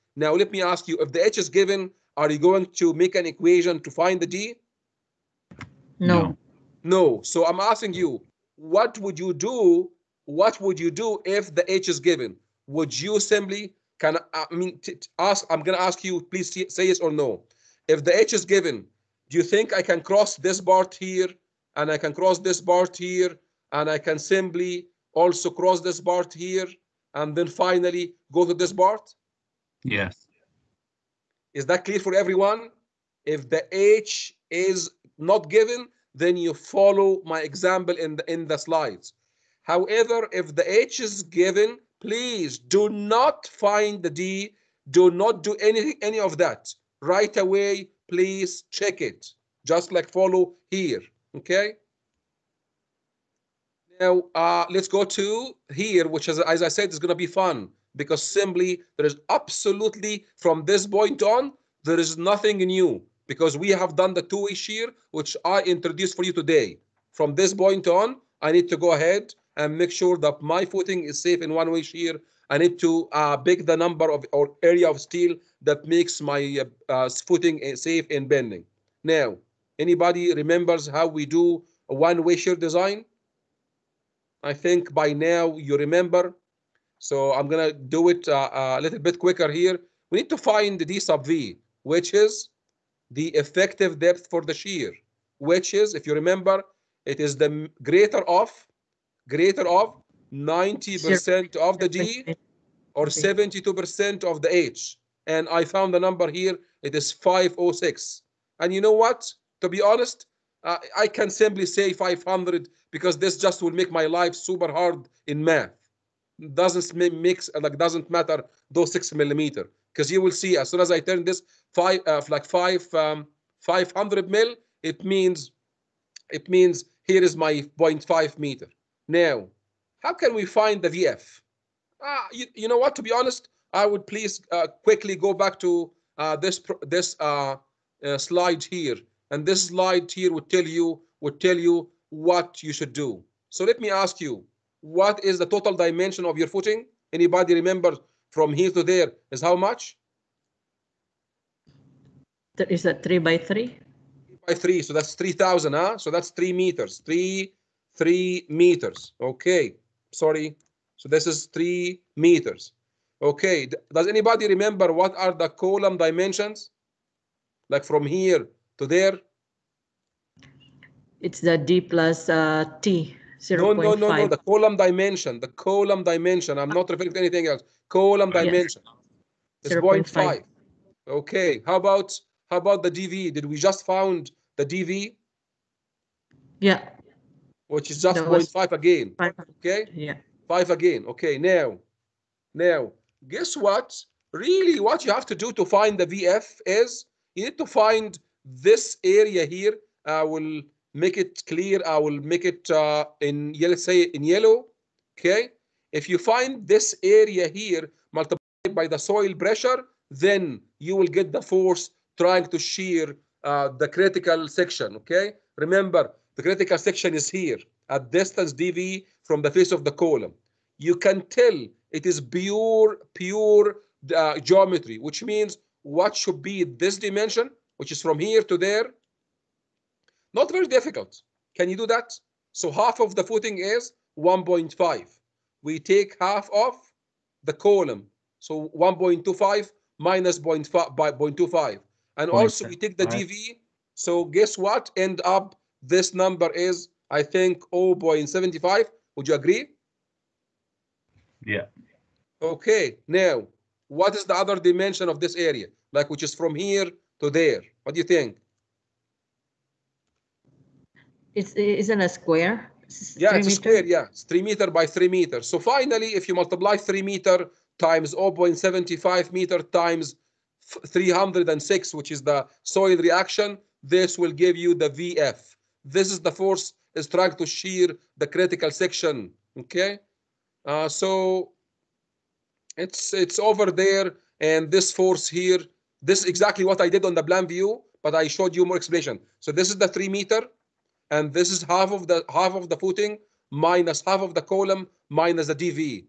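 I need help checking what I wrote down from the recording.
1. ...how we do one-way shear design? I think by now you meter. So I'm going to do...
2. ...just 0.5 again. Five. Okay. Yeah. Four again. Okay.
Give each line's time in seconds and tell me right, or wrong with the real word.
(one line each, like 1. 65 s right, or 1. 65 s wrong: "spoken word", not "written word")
1. 80 s wrong: "remember", not "meter"
2. 188 s wrong: "Five", not "Four".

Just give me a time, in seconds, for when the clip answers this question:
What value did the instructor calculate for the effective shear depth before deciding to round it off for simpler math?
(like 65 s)
107 s.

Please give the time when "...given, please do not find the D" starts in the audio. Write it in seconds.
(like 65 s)
41 s.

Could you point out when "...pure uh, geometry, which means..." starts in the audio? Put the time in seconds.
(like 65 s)
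223 s.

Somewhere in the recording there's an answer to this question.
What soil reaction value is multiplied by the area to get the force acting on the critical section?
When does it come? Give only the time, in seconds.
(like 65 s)
270 s.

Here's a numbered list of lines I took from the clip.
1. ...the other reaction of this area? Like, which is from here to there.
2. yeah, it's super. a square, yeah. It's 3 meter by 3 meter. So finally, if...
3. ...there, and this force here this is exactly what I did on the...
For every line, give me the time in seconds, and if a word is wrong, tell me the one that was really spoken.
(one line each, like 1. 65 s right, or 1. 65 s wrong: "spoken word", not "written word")
1. 254 s wrong: "dimension", not "reaction"
2. 263 s wrong: "meter", not "super"
3. 283 s right.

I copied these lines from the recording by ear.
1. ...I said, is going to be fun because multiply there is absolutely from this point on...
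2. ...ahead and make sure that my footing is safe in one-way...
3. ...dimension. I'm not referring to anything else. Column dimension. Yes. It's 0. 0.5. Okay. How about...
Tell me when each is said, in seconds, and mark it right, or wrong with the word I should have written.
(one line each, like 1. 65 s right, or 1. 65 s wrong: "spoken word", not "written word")
1. 56 s wrong: "simply", not "multiply"
2. 68 s right
3. 176 s right.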